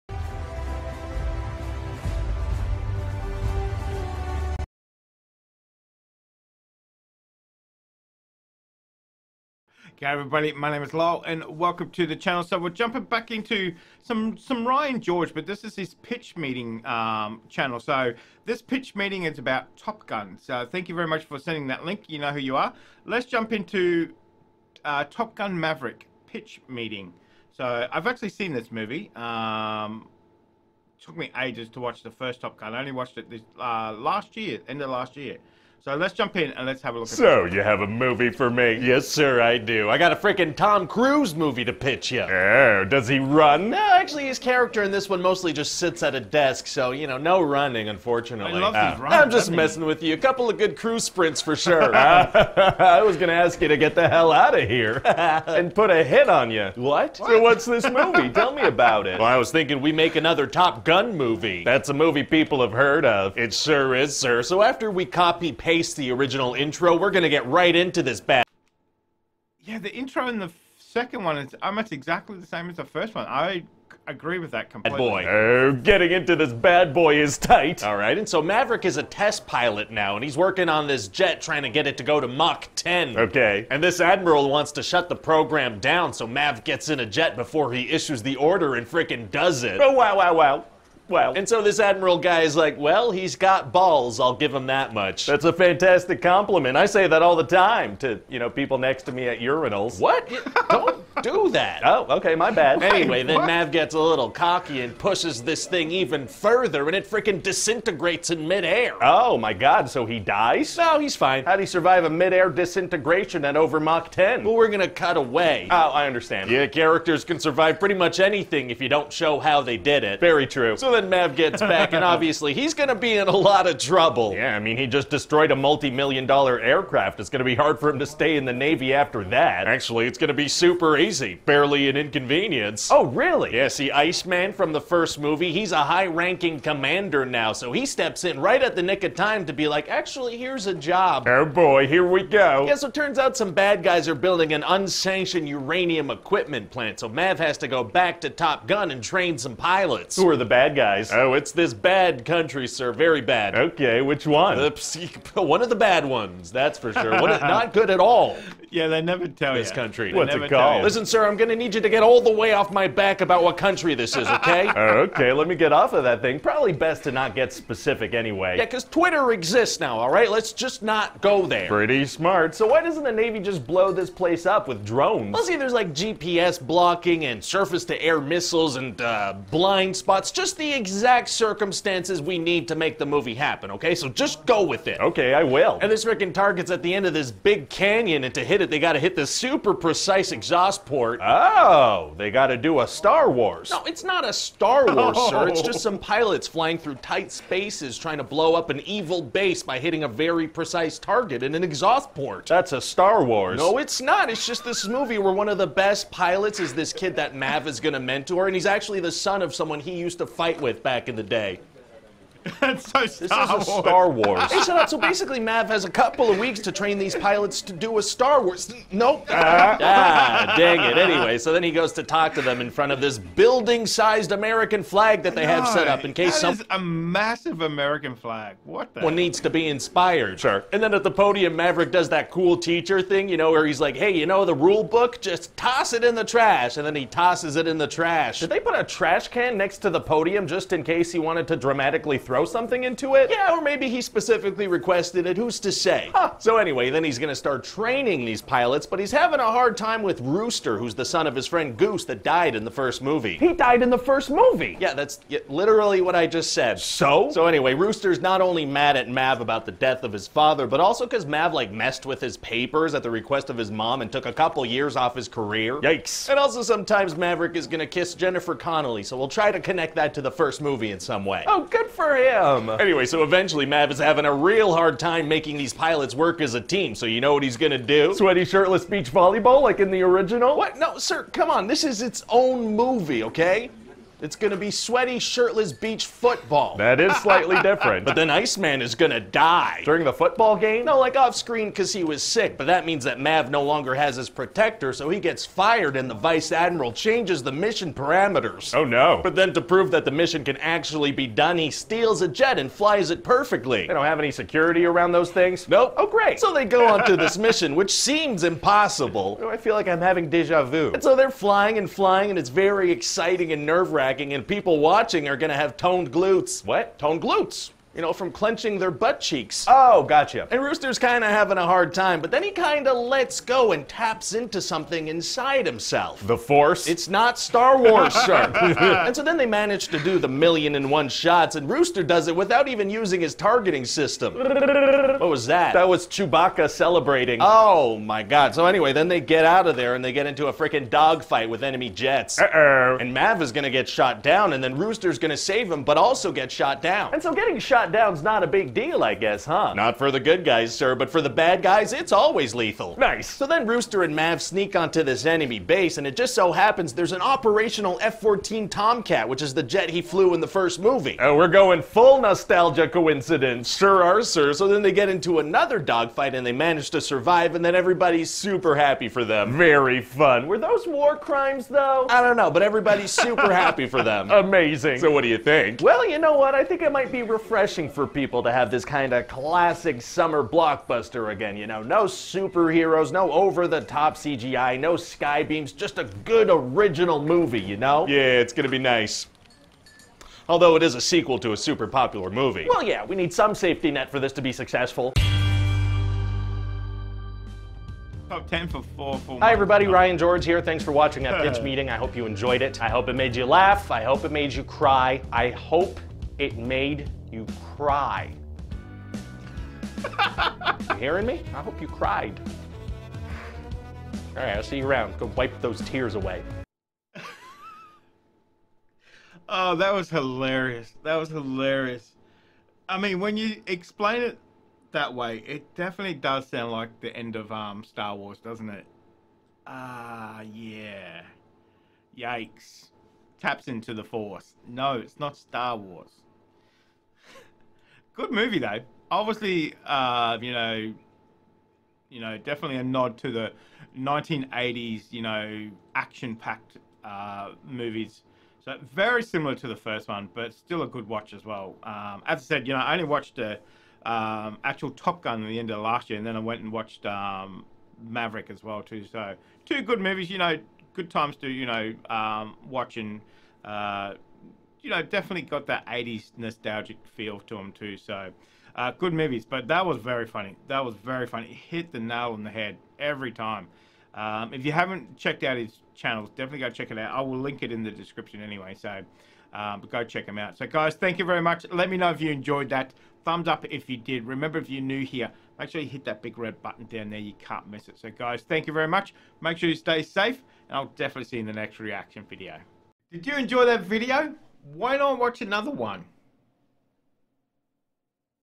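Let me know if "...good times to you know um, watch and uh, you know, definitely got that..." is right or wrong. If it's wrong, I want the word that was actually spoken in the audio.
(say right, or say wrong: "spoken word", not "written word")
right.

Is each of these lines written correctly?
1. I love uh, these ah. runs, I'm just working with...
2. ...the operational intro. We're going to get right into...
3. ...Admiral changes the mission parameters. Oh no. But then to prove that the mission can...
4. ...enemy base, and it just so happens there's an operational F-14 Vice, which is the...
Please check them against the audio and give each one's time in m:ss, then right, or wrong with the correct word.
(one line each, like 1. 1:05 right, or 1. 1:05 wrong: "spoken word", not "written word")
1. 0:48 wrong: "messing", not "working"
2. 1:05 wrong: "original", not "operational"
3. 4:56 right
4. 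5:55 wrong: "Tomcat", not "Vice".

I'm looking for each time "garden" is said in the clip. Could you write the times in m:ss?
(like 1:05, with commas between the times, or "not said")
not said.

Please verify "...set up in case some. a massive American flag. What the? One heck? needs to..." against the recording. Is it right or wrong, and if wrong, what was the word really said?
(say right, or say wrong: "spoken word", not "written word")
right.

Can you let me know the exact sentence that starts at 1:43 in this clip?
Mav gets a little cocky and pushes this thing even further, and it freaking disintegrates in midair.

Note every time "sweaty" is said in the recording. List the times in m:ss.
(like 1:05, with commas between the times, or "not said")
4:38, 4:44.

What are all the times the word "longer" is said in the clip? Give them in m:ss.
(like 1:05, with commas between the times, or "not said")
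4:53.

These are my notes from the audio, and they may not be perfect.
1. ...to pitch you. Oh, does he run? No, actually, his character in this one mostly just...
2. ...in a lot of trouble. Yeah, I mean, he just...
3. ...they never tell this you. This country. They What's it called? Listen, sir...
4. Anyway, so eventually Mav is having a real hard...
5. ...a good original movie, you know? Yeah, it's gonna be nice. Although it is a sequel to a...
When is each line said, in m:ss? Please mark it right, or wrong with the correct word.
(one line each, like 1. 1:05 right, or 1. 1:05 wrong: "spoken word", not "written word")
1. 0:41 right
2. 2:03 right
3. 2:38 right
4. 4:32 right
5. 6:25 right.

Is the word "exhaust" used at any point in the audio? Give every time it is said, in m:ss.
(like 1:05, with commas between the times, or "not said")
3:10, 3:21.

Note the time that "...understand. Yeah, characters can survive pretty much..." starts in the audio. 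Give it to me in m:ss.
1:56.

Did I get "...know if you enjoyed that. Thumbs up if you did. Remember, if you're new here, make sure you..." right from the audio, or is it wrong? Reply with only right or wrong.
right.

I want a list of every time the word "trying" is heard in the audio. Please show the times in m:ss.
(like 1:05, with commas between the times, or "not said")
1:21, 3:17.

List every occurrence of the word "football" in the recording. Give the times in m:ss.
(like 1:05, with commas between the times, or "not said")
4:46, 4:50.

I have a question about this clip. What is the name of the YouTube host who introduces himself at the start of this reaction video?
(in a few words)
Lyle.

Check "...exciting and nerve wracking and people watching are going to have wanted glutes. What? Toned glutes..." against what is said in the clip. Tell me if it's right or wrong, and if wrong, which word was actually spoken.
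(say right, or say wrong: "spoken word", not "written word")
wrong: "toned", not "wanted".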